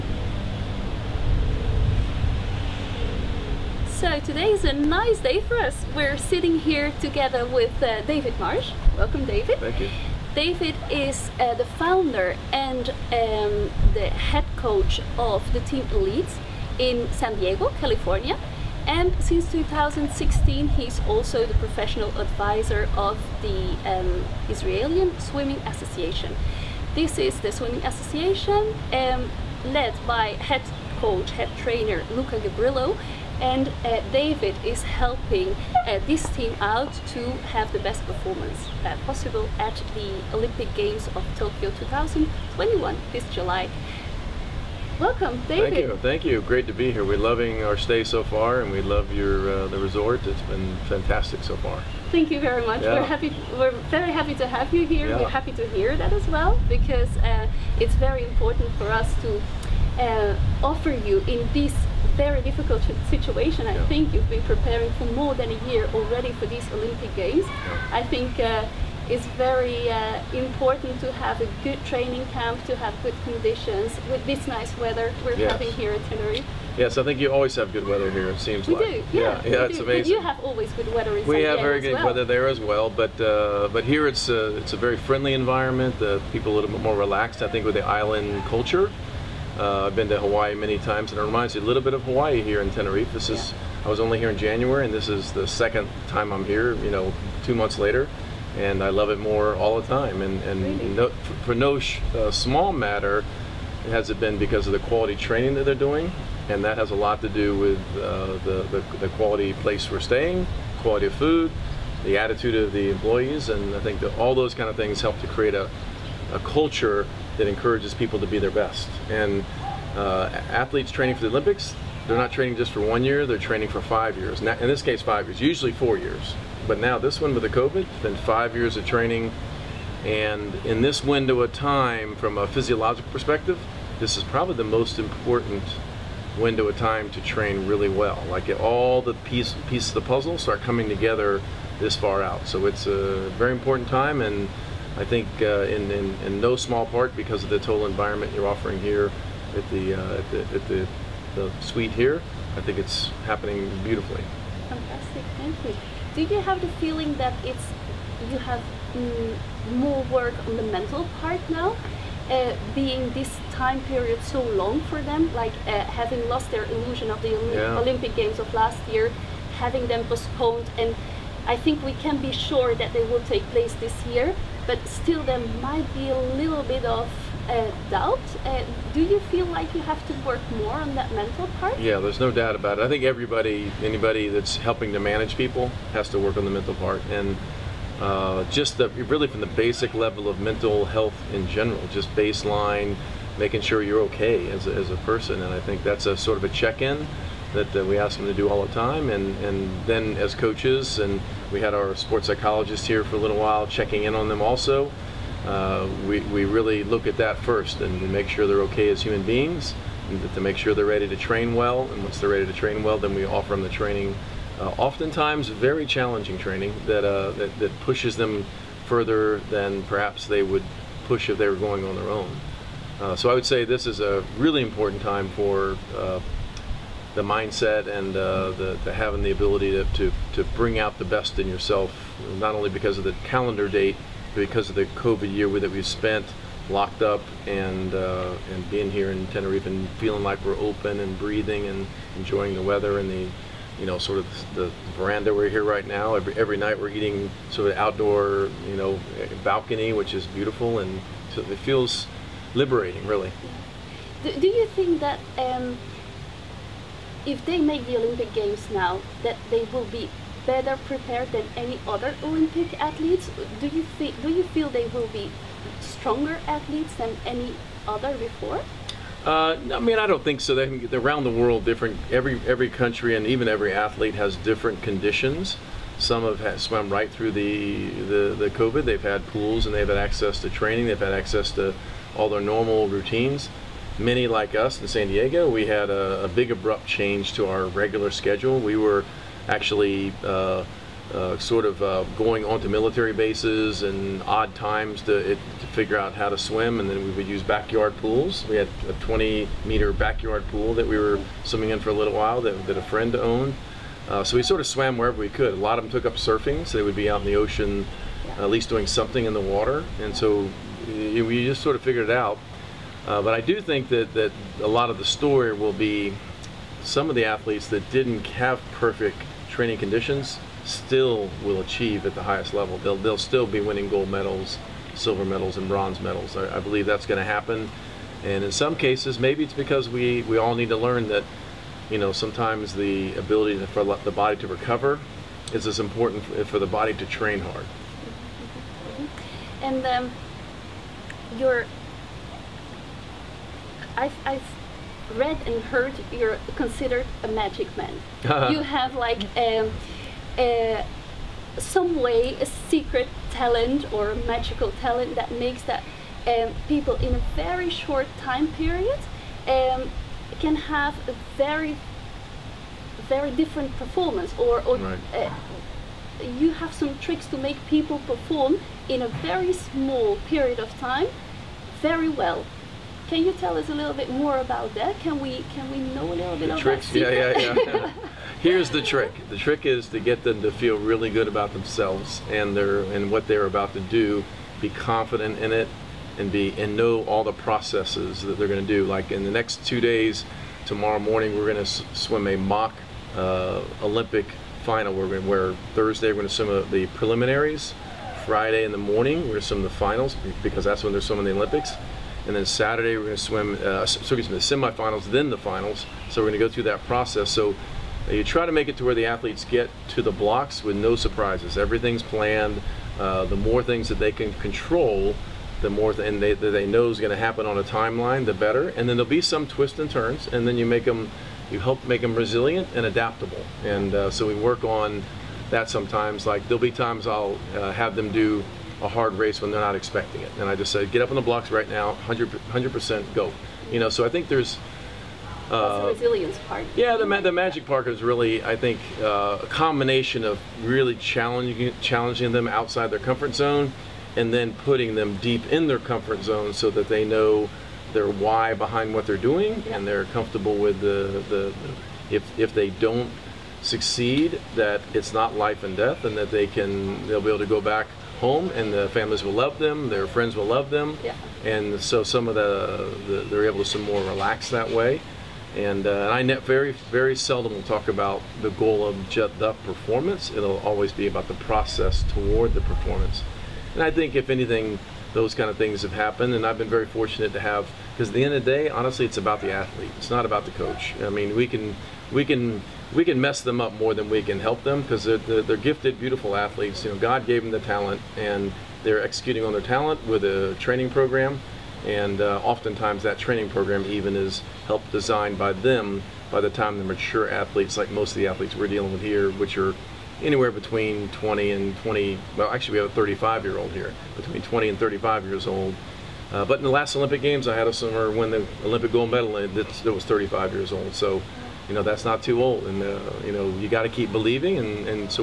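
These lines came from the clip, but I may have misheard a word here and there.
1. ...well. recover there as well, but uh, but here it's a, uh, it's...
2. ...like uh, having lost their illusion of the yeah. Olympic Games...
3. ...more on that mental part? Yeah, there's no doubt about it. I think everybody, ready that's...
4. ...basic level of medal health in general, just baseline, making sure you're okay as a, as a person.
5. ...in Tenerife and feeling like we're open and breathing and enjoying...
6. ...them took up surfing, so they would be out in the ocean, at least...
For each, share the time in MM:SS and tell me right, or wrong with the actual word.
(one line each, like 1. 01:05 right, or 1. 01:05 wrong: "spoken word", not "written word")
1. 01:21 wrong: "weather", not "recover"
2. 02:45 right
3. 03:00 wrong: "anybody", not "ready"
4. 03:09 wrong: "mental", not "medal"
5. 03:59 right
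6. 05:05 right.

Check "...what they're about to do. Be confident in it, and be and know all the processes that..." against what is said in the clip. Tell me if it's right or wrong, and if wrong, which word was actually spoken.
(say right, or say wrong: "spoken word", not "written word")
right.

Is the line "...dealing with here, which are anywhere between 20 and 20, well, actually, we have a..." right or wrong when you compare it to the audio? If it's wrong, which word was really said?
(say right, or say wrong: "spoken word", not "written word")
right.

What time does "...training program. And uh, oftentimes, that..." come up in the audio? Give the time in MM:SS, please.
08:10.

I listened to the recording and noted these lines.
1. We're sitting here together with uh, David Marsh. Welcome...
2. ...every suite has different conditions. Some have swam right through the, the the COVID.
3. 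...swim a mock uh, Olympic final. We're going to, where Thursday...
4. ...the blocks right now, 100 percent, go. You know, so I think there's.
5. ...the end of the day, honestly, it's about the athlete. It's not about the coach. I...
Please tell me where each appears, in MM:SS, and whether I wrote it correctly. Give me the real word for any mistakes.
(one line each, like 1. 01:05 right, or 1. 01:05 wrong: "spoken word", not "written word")
1. 00:05 right
2. 04:33 wrong: "athlete", not "suite"
3. 06:31 right
4. 07:11 right
5. 07:58 right.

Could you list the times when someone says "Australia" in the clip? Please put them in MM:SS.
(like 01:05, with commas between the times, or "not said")
not said.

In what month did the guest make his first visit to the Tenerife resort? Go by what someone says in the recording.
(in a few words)
January.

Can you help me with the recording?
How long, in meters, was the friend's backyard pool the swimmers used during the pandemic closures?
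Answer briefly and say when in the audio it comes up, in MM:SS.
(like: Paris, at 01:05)
20 meters, at 04:58.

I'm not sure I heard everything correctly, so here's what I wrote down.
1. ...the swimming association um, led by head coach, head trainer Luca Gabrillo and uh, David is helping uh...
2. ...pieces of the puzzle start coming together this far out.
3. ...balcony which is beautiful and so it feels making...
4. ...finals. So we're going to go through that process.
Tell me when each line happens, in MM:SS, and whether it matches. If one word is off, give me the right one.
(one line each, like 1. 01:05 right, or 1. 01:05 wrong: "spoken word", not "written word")
1. 00:27 right
2. 02:19 right
3. 04:09 wrong: "liberating", not "making"
4. 06:45 right.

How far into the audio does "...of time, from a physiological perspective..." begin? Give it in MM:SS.
02:11.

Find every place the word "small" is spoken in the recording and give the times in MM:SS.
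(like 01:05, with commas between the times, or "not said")
01:42, 02:26, 06:09.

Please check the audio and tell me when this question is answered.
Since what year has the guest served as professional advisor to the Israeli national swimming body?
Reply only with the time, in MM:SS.
00:19.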